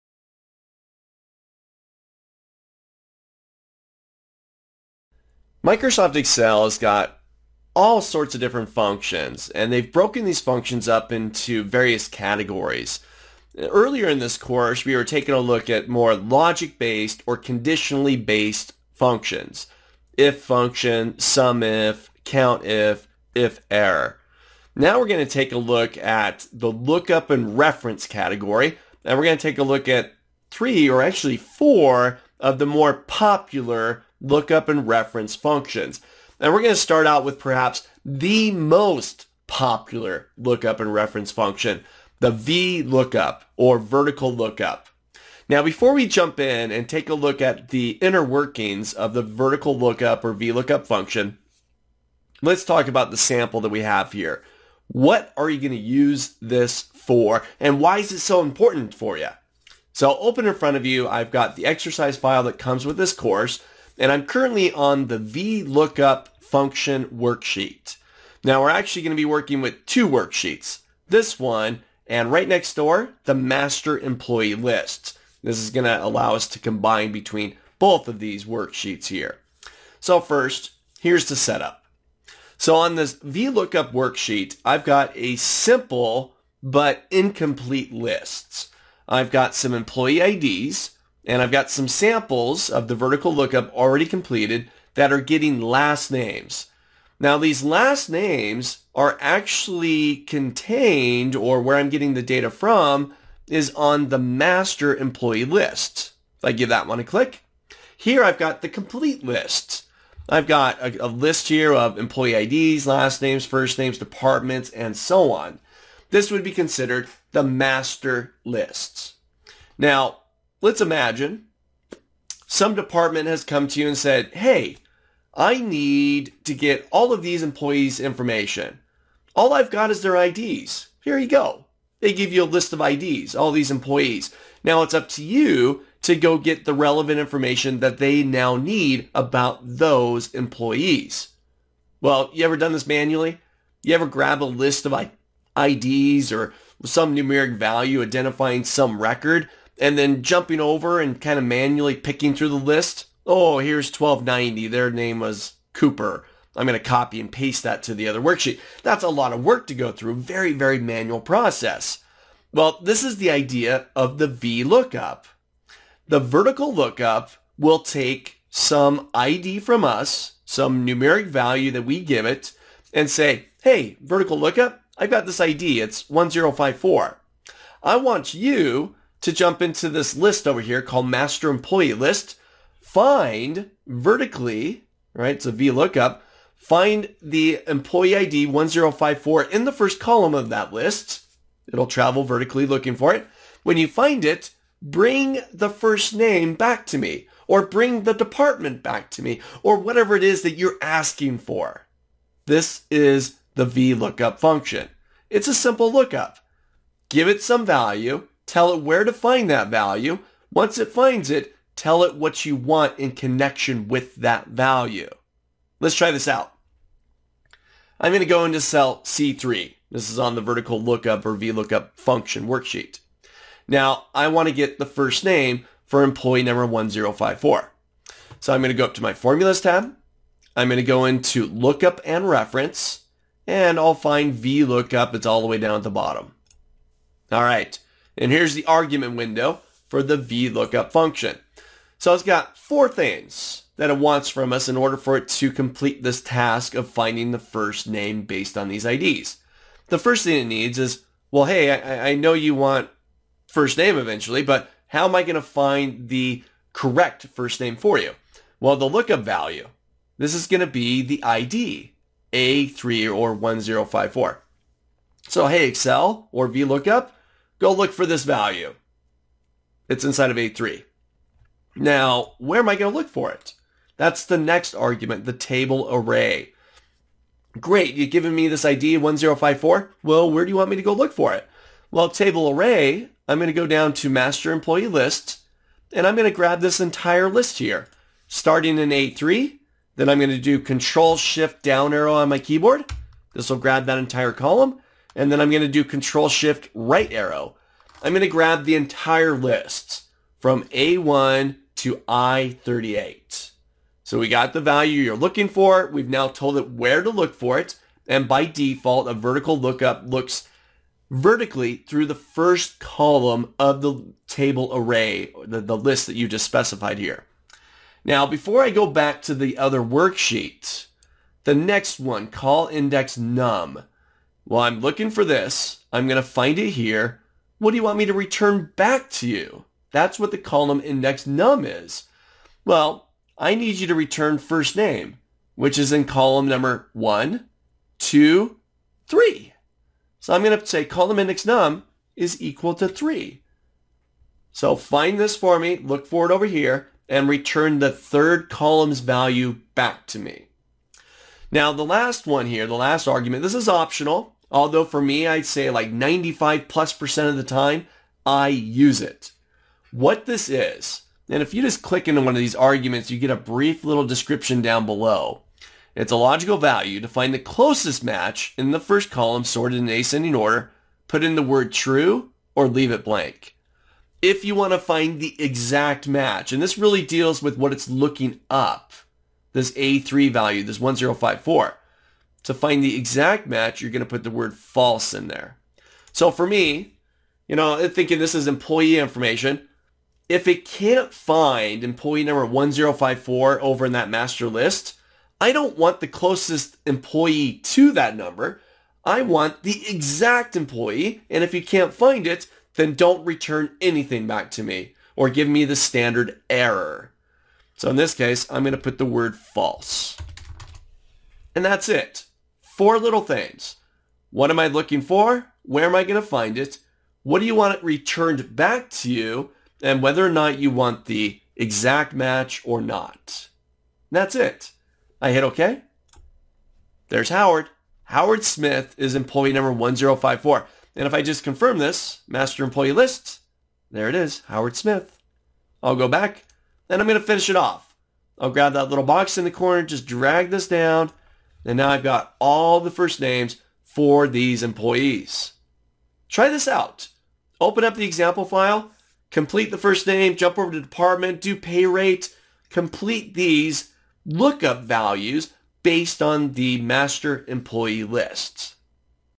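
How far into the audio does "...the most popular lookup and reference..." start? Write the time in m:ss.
0:38.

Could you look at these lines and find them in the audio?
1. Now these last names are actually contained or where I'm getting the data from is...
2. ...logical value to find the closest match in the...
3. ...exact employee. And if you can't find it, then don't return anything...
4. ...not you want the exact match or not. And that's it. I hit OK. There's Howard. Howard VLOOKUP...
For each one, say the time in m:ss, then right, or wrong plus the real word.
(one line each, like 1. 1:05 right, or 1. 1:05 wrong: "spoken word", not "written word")
1. 1:37 right
2. 6:06 right
3. 6:39 right
4. 7:00 wrong: "Smith", not "VLOOKUP".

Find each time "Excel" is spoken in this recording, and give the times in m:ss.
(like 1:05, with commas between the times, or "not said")
0:06, 4:25.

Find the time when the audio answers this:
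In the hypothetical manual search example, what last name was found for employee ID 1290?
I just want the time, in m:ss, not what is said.
2:35.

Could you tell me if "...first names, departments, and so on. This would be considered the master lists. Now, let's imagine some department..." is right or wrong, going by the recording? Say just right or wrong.
right.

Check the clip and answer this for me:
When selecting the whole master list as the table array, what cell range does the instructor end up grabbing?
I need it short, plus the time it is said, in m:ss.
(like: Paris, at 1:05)
A1 to I38, at 5:00.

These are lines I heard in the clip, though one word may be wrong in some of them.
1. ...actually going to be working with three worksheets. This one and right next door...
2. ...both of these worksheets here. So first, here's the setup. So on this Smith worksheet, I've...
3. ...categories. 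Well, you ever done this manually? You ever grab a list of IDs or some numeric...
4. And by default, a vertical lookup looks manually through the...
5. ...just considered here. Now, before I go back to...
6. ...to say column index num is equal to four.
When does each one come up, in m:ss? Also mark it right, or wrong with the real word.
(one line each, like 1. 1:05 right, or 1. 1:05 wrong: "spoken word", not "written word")
1. 1:08 wrong: "two", not "three"
2. 1:17 wrong: "VLOOKUP", not "Smith"
3. 2:20 wrong: "employees", not "categories"
4. 5:08 wrong: "vertically", not "manually"
5. 5:16 wrong: "specified", not "considered"
6. 5:40 wrong: "three", not "four".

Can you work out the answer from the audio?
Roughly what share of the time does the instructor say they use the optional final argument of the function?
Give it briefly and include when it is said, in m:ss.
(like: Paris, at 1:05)
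95 plus percent, at 5:55.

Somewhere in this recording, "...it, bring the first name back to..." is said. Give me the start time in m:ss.
3:14.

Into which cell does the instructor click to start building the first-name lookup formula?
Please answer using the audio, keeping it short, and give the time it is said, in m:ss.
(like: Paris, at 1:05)
C3, at 3:39.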